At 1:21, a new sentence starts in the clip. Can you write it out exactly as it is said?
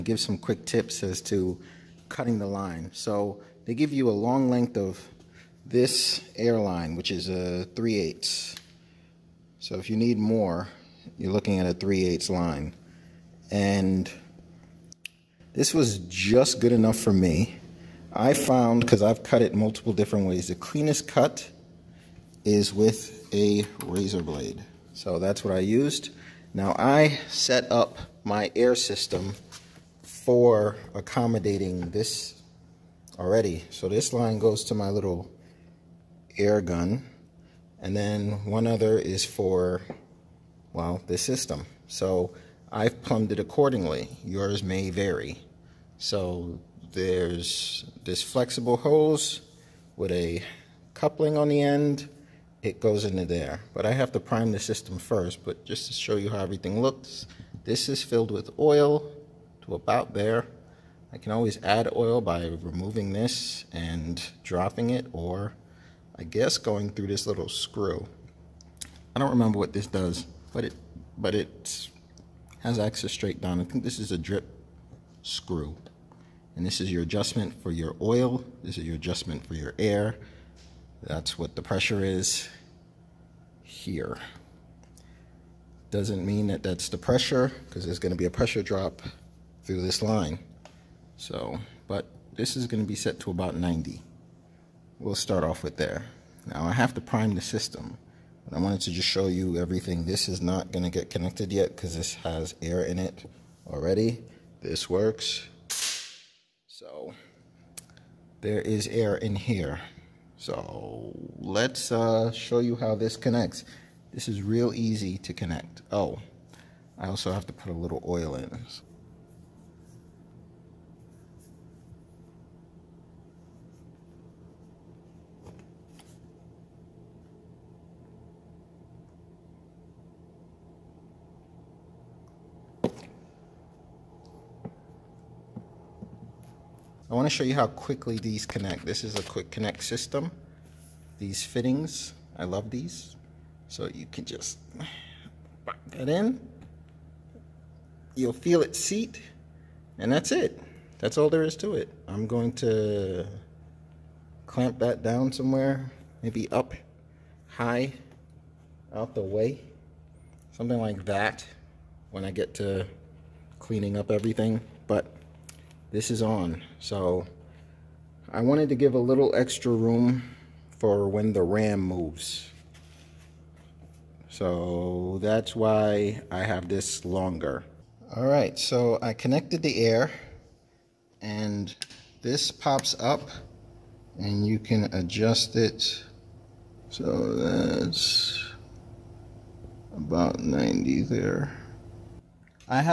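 That's what the pressure is here.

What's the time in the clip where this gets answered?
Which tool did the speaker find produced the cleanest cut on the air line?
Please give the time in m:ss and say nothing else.
0:23.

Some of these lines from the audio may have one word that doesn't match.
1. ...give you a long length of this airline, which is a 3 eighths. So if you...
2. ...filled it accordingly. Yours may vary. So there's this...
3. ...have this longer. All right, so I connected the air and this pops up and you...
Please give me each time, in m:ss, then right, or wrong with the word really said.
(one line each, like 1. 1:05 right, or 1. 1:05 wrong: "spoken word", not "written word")
1. 0:03 right
2. 0:43 wrong: "plumbed", not "filled"
3. 2:56 right.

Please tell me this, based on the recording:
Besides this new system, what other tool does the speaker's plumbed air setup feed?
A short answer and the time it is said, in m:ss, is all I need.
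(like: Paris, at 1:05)
Air gun, at 0:36.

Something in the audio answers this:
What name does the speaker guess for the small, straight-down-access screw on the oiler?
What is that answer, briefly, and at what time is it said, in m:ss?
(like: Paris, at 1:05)
Drip screw, at 1:14.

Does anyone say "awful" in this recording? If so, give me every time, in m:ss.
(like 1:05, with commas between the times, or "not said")
not said.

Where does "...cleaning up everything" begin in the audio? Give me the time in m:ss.
2:43.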